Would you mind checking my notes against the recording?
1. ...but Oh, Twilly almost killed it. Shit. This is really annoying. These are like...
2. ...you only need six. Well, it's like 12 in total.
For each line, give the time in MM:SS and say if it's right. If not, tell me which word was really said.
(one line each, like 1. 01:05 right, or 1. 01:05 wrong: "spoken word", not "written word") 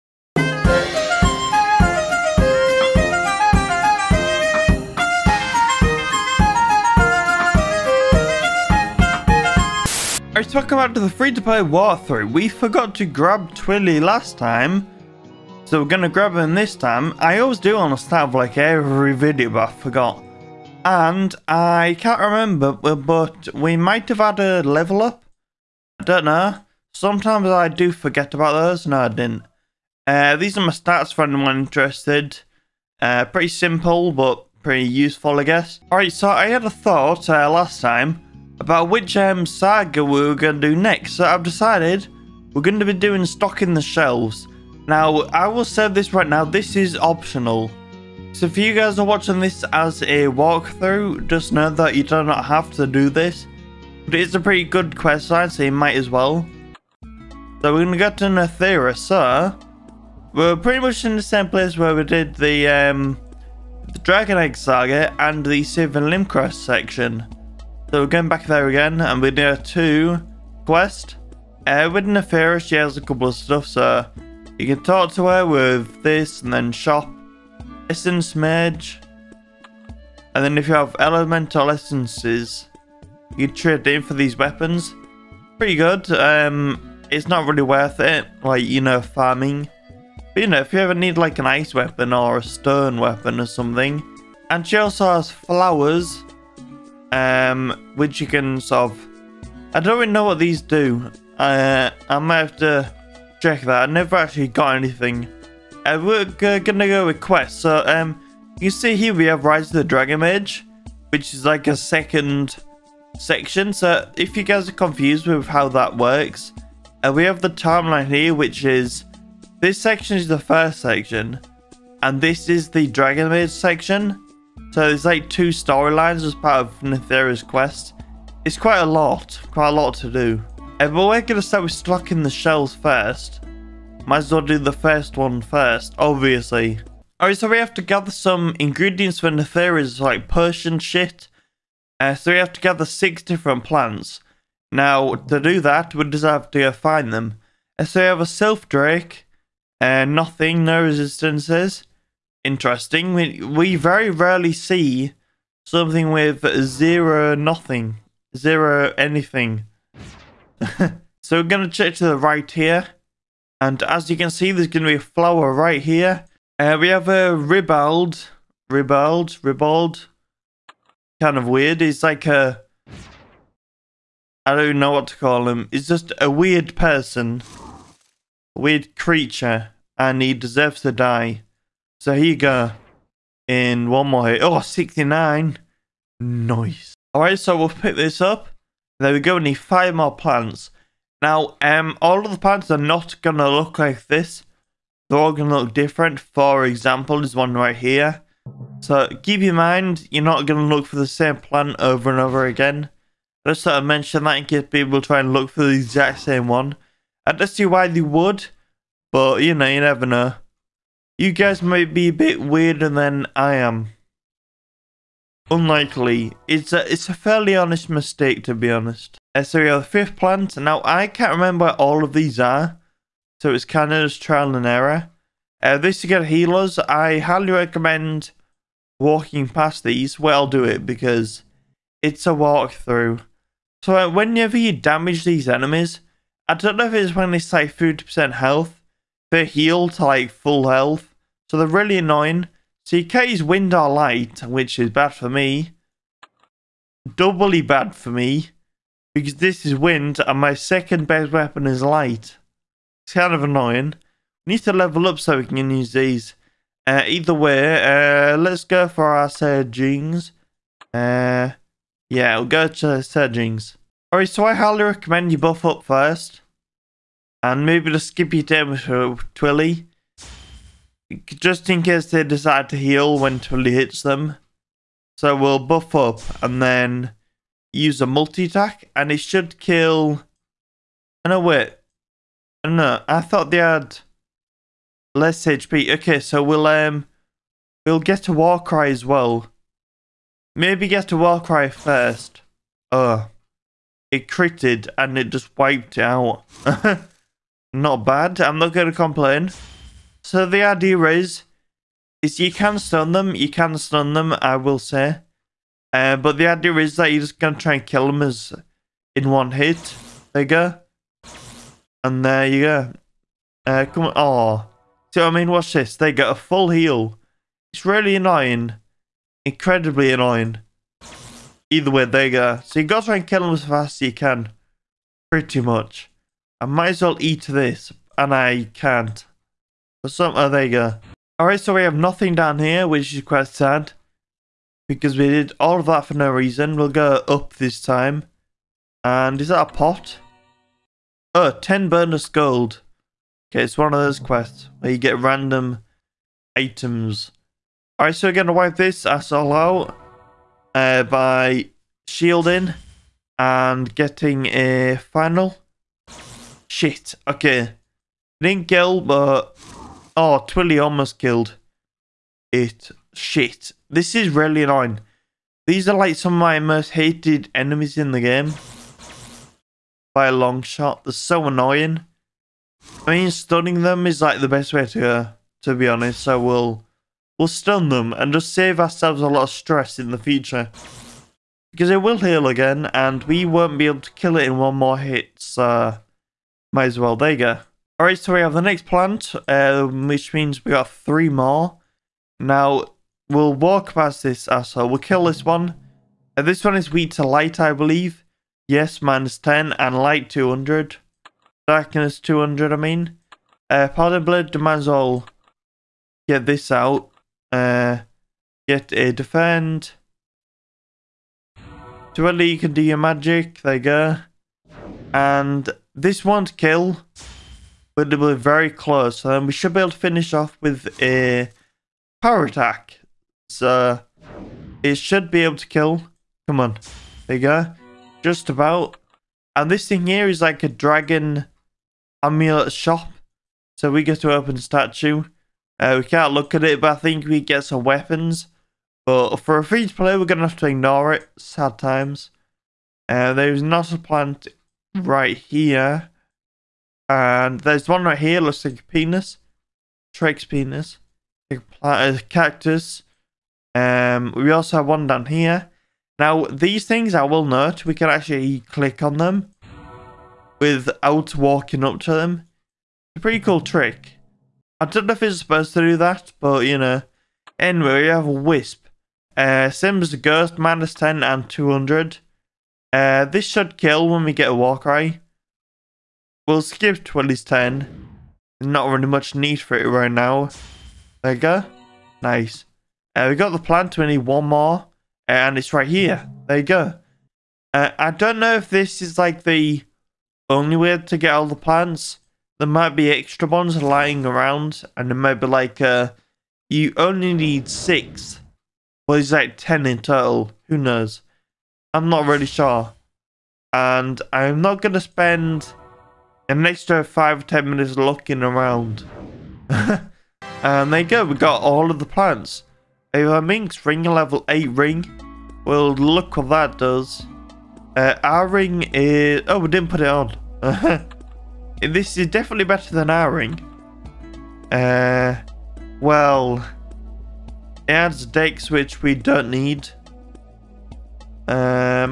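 1. 05:58 right
2. 08:16 wrong: "10", not "12".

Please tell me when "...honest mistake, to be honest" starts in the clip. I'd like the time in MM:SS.
03:37.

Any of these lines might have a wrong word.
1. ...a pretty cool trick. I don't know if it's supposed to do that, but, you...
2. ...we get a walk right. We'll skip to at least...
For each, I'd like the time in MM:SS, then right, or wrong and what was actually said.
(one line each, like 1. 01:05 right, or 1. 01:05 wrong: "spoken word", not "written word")
1. 07:43 right
2. 07:54 right.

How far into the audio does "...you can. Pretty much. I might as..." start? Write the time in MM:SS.
05:24.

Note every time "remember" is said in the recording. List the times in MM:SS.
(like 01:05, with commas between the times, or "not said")
00:22, 03:41.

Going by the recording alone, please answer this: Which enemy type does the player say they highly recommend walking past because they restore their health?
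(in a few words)
Healers.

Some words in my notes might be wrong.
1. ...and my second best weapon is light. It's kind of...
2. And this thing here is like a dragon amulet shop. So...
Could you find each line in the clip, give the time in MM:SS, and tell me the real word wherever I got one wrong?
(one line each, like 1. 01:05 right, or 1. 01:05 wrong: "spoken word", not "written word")
1. 04:10 right
2. 07:09 right.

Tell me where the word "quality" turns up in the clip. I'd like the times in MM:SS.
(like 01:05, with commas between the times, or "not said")
not said.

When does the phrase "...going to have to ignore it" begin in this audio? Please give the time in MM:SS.
07:20.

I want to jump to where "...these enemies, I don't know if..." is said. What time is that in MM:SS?
03:55.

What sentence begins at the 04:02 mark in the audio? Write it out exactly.
CK's wind are light, which is bad for me.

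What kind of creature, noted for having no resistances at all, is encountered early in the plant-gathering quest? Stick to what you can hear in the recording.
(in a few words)
Sylph Drake.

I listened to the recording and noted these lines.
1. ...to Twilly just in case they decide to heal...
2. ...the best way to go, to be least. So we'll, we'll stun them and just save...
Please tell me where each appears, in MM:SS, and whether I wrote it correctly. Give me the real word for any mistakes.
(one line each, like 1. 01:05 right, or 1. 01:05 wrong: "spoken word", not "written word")
1. 04:28 right
2. 06:14 wrong: "honest", not "least".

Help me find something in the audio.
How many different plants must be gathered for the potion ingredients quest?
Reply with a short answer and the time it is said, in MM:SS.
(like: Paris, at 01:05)
6, at 02:22.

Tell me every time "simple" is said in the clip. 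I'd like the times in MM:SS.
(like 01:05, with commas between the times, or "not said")
00:33.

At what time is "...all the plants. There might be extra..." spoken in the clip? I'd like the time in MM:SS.
08:11.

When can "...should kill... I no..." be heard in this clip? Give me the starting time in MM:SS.
04:39.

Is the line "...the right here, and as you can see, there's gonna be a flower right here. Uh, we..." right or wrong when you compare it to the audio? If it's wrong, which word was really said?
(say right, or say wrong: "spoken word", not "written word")
right.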